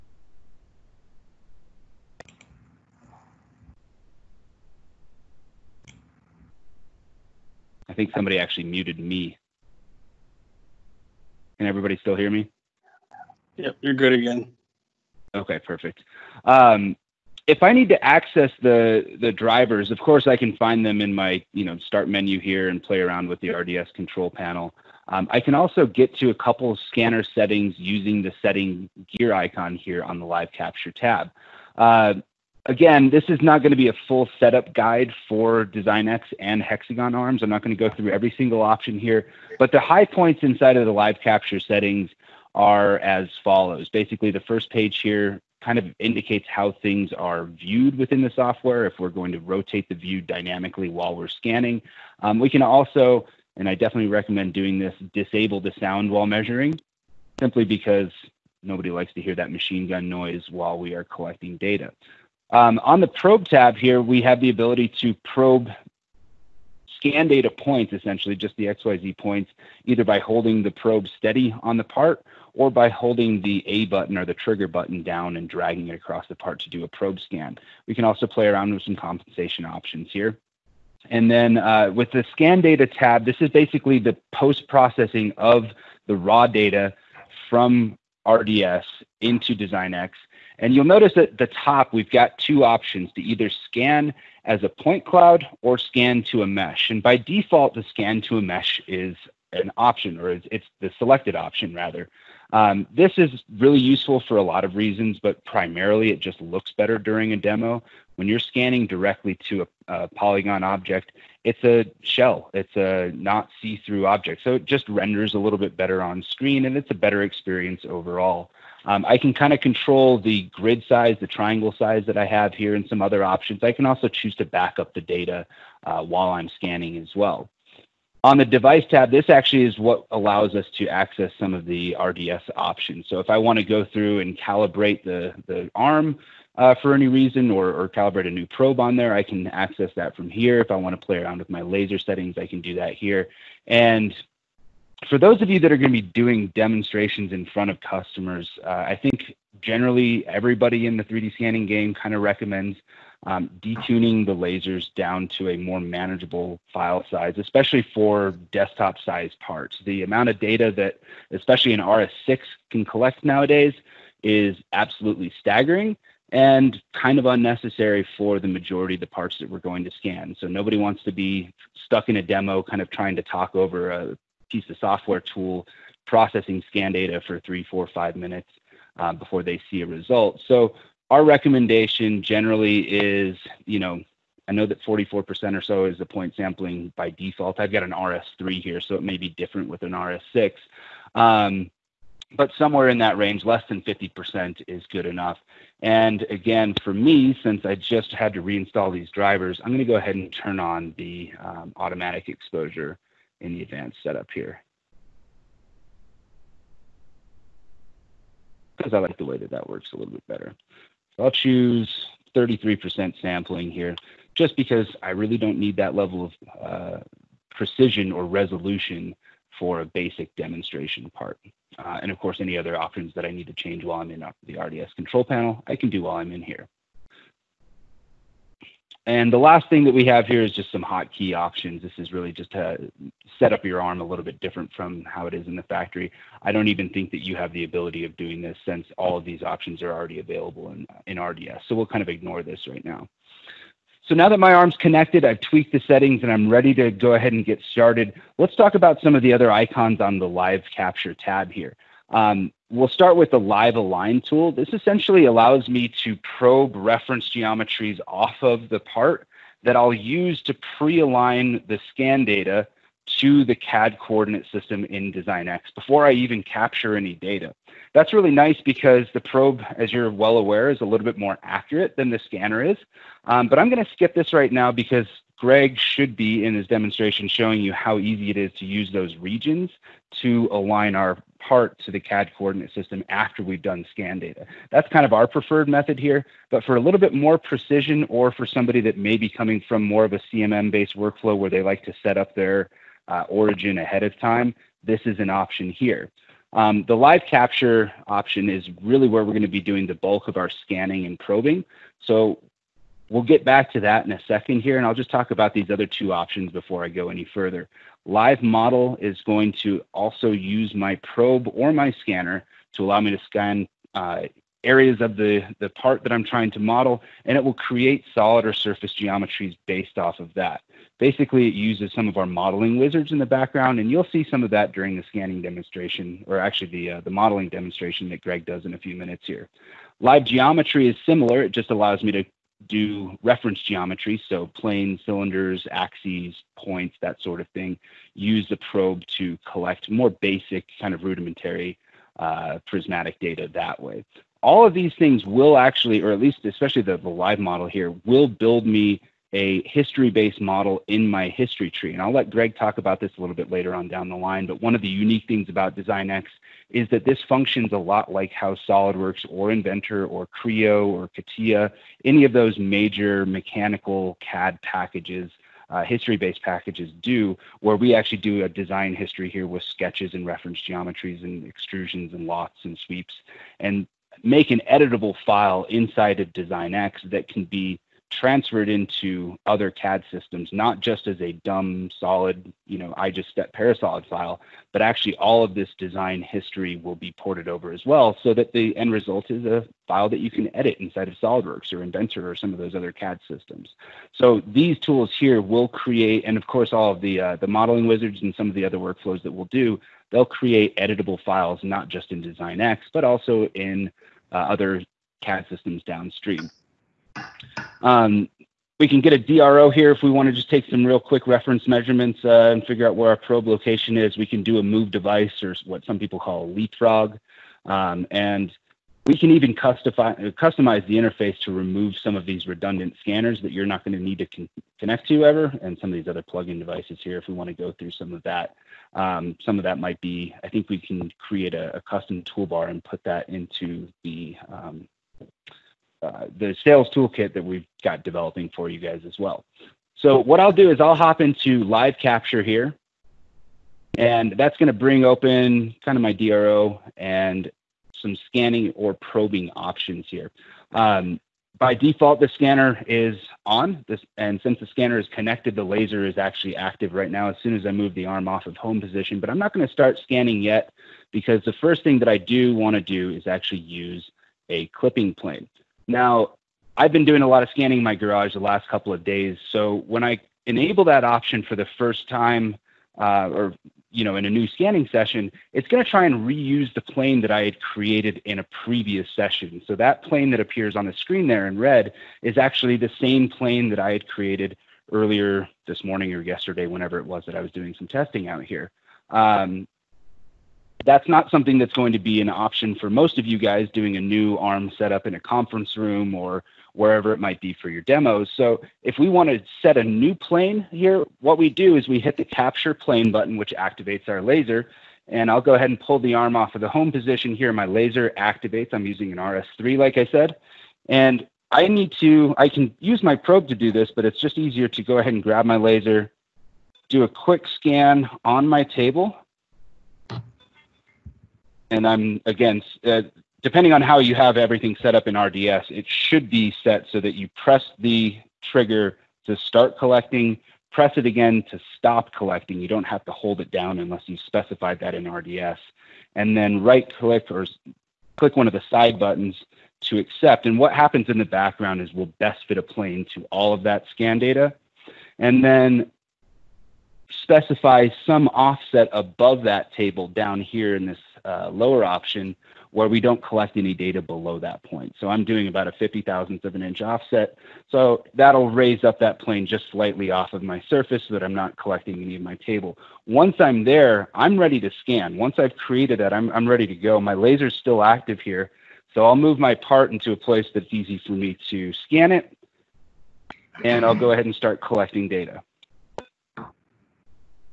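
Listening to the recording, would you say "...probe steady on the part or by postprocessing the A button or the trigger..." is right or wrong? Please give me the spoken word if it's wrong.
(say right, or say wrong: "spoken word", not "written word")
wrong: "holding", not "postprocessing".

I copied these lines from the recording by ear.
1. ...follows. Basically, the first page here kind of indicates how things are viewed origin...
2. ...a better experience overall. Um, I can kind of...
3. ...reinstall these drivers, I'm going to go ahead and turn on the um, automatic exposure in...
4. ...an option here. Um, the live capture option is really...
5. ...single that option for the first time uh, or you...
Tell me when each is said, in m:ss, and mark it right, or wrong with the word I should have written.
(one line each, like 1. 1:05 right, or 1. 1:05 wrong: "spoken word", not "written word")
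1. 0:43 wrong: "within", not "origin"
2. 1:56 right
3. 3:18 right
4. 4:55 right
5. 7:50 wrong: "enable", not "single".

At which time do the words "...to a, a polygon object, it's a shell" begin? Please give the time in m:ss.
1:49.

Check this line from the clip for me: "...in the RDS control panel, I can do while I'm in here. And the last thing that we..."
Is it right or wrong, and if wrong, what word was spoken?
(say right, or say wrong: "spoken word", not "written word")
right.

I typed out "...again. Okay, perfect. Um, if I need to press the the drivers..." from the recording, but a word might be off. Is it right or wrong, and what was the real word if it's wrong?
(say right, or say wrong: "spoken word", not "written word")
wrong: "access", not "press".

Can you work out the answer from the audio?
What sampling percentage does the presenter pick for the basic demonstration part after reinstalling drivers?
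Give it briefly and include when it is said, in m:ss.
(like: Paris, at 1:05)
33%, at 3:32.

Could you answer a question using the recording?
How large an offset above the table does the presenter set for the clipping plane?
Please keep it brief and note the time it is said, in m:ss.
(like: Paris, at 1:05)
50 thousandths of an inch, at 9:15.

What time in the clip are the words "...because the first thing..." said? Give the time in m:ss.
7:41.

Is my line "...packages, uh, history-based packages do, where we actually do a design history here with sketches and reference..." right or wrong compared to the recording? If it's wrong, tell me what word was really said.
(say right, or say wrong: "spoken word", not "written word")
right.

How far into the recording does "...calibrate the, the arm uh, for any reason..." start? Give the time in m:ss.
2:14.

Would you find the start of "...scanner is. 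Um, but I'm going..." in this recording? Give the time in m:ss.
4:32.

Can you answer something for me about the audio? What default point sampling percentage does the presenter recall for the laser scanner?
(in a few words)
44%.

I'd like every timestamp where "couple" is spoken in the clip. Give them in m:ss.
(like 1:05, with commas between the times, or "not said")
0:26, 7:48.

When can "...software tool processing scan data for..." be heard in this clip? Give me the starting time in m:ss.
2:54.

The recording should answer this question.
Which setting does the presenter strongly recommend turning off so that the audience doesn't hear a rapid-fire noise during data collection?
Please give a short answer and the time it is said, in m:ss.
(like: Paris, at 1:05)
Sound while measuring, at 0:55.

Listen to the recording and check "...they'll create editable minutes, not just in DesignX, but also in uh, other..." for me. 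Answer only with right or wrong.
wrong.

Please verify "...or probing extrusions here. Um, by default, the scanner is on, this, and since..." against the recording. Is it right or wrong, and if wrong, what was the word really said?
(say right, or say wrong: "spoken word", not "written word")
wrong: "options", not "extrusions".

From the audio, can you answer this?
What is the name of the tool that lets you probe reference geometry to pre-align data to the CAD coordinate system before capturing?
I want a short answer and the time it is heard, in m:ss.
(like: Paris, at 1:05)
Live align, at 4:13.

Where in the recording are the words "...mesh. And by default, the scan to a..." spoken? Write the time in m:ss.
1:36.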